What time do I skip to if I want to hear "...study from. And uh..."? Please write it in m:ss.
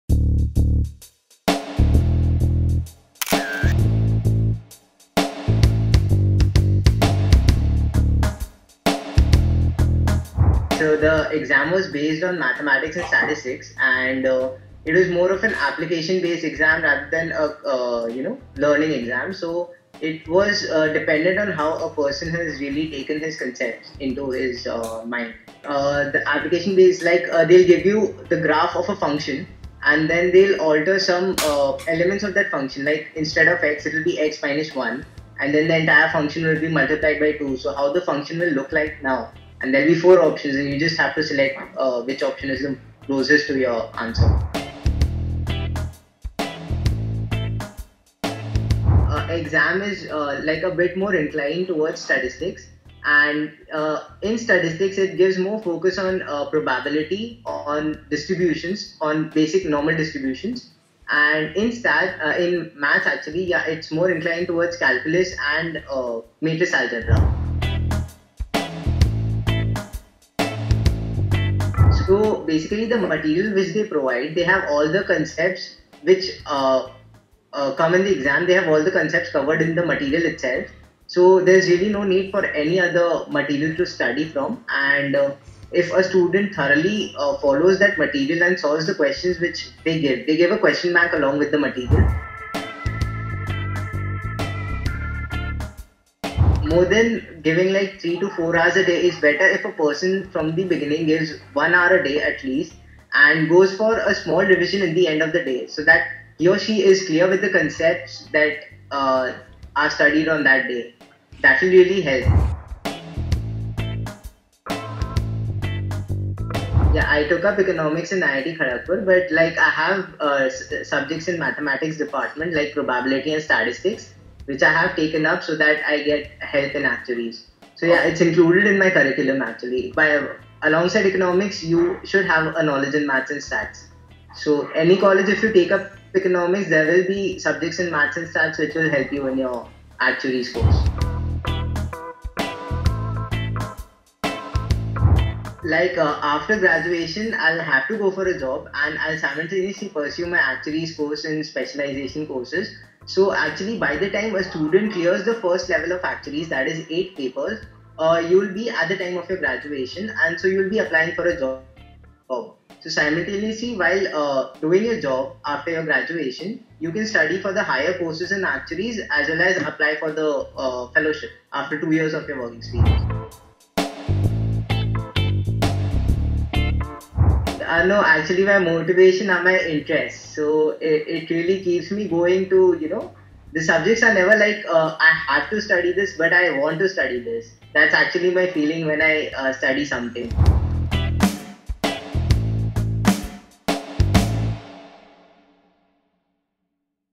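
1:23.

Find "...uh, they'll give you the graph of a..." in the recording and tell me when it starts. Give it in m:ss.
0:27.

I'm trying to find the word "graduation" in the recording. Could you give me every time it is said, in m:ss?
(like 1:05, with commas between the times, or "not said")
2:26, 2:39, 2:45.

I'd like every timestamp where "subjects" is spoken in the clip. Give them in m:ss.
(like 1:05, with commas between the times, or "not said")
2:00, 2:17, 3:03.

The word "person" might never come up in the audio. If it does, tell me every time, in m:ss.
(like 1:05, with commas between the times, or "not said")
0:21, 1:39.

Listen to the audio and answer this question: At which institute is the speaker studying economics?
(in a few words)
IIT Kharagpur.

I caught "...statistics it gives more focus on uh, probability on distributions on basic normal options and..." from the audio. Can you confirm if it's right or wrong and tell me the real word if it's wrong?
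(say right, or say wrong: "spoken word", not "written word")
wrong: "distributions", not "options".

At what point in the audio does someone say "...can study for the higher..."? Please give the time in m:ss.
2:46.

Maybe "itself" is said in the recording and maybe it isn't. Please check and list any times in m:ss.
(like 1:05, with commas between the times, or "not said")
1:20.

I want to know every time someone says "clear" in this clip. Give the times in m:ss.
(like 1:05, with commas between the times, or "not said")
1:47, 2:34.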